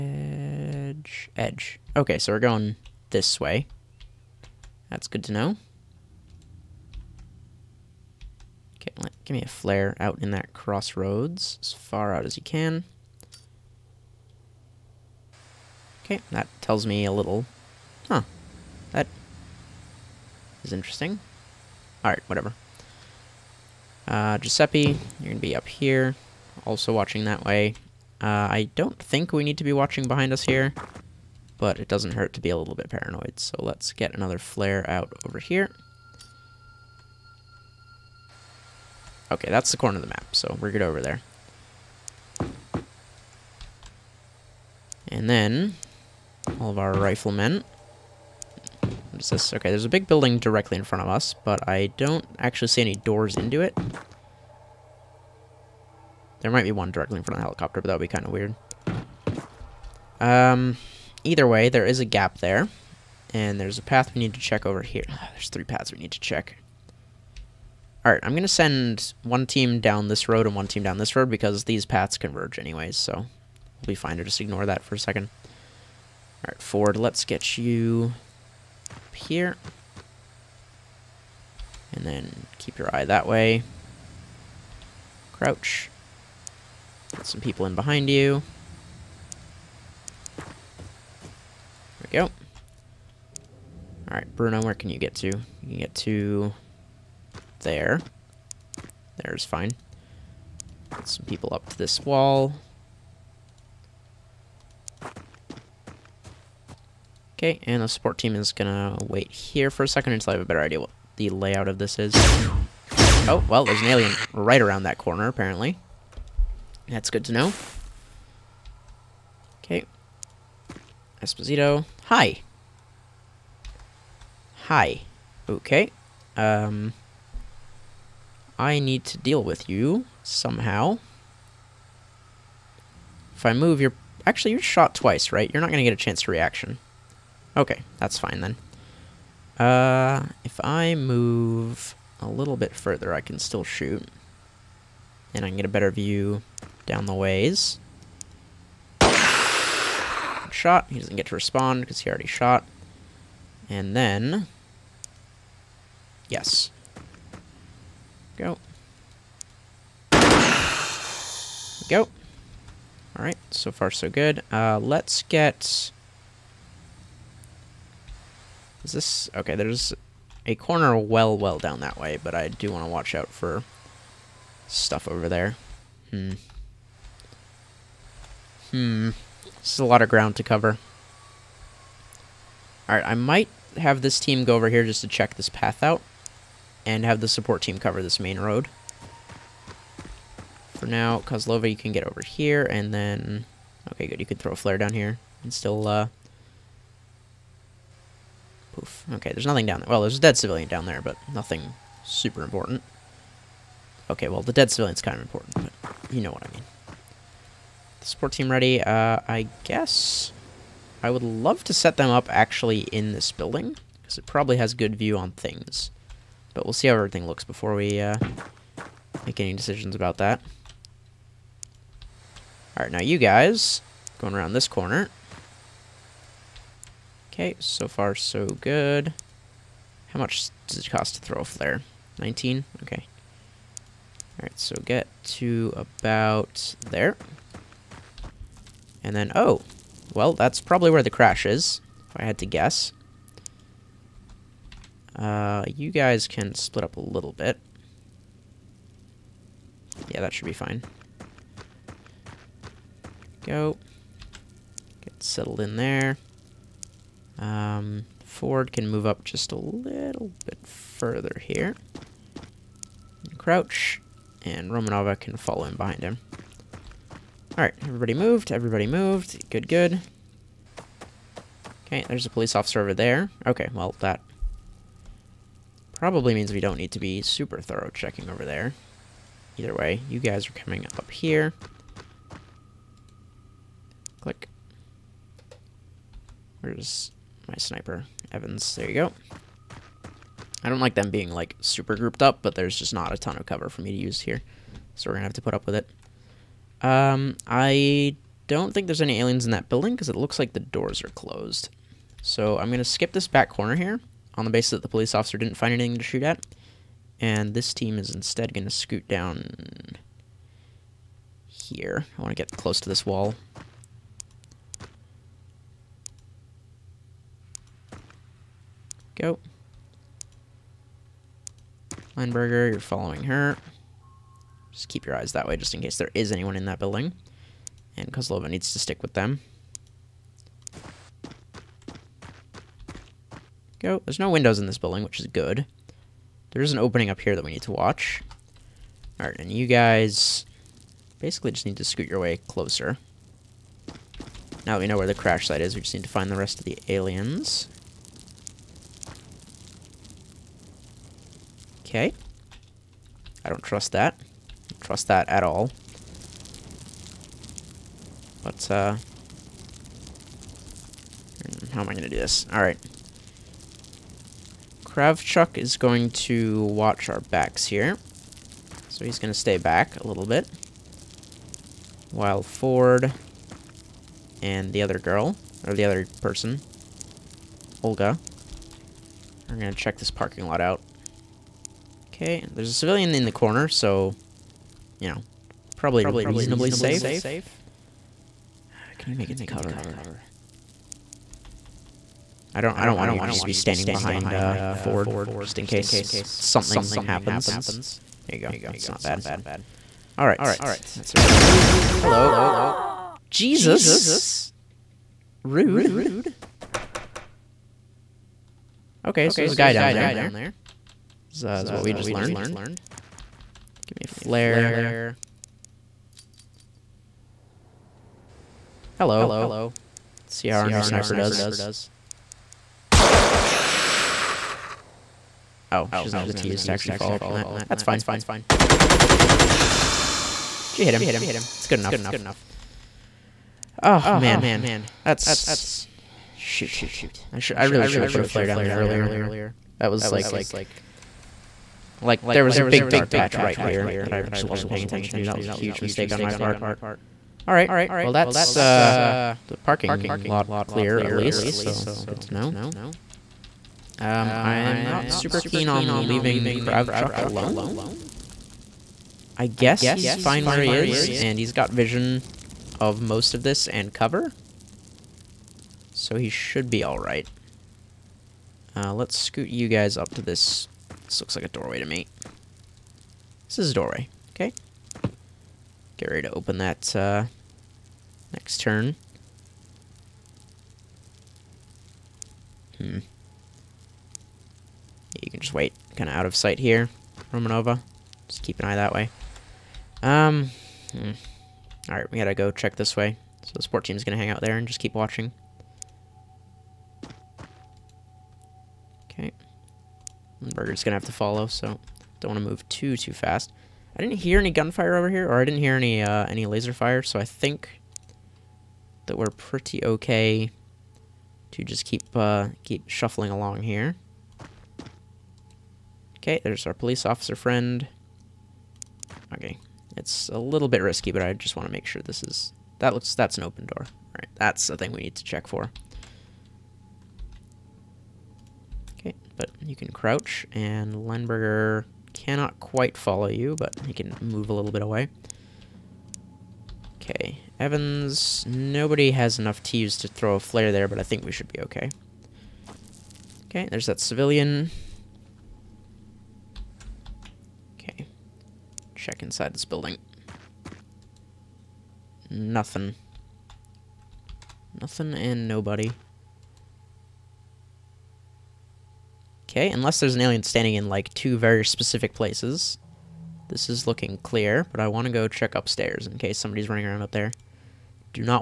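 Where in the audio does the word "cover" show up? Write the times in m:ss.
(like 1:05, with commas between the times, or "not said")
3:00, 3:07, 4:53, 6:29, 7:43.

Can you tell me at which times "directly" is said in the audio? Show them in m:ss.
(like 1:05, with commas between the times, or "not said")
0:50, 0:56.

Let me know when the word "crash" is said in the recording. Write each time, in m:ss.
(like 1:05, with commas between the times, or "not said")
4:01, 5:45.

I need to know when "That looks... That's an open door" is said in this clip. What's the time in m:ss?
8:42.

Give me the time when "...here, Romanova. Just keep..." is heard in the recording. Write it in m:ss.
8:06.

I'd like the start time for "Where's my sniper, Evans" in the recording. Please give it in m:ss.
4:46.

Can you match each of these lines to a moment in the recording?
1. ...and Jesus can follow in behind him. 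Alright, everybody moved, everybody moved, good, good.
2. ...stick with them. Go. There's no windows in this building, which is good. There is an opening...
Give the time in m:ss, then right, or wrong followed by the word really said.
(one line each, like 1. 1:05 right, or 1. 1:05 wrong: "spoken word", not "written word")
1. 4:24 wrong: "Romanova", not "Jesus"
2. 5:28 right.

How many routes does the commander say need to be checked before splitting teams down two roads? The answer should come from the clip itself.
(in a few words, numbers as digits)
3.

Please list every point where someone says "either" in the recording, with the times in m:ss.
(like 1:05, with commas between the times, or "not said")
1:01, 4:39.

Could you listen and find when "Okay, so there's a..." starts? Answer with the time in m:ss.
6:49.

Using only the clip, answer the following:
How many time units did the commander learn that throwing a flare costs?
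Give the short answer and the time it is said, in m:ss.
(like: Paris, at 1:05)
19, at 3:52.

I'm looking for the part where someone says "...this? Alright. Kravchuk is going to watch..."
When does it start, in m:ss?
6:02.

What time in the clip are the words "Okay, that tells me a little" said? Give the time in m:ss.
0:16.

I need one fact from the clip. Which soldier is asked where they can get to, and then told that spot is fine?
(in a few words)
Bruno.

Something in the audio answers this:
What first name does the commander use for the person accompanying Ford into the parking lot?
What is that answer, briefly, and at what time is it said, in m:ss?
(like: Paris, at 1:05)
Olga, at 6:17.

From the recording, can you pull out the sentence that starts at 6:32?
I don't I don't want you just to be standing behind uh, Ford, just in case something happens.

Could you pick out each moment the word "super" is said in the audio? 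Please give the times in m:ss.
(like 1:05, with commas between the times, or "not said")
3:22, 4:37, 4:51, 7:35.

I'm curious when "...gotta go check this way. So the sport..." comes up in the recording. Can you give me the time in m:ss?
8:12.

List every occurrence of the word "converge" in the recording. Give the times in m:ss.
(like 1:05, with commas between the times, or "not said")
1:12.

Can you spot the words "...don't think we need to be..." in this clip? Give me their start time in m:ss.
0:28.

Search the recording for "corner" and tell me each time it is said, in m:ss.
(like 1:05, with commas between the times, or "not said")
0:39, 1:54, 2:50, 3:44, 5:03, 6:23.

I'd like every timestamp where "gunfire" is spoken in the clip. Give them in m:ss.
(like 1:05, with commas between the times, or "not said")
8:24.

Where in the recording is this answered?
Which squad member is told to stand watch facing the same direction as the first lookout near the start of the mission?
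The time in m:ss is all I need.
0:24.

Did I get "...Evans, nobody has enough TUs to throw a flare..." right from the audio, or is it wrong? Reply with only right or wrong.
right.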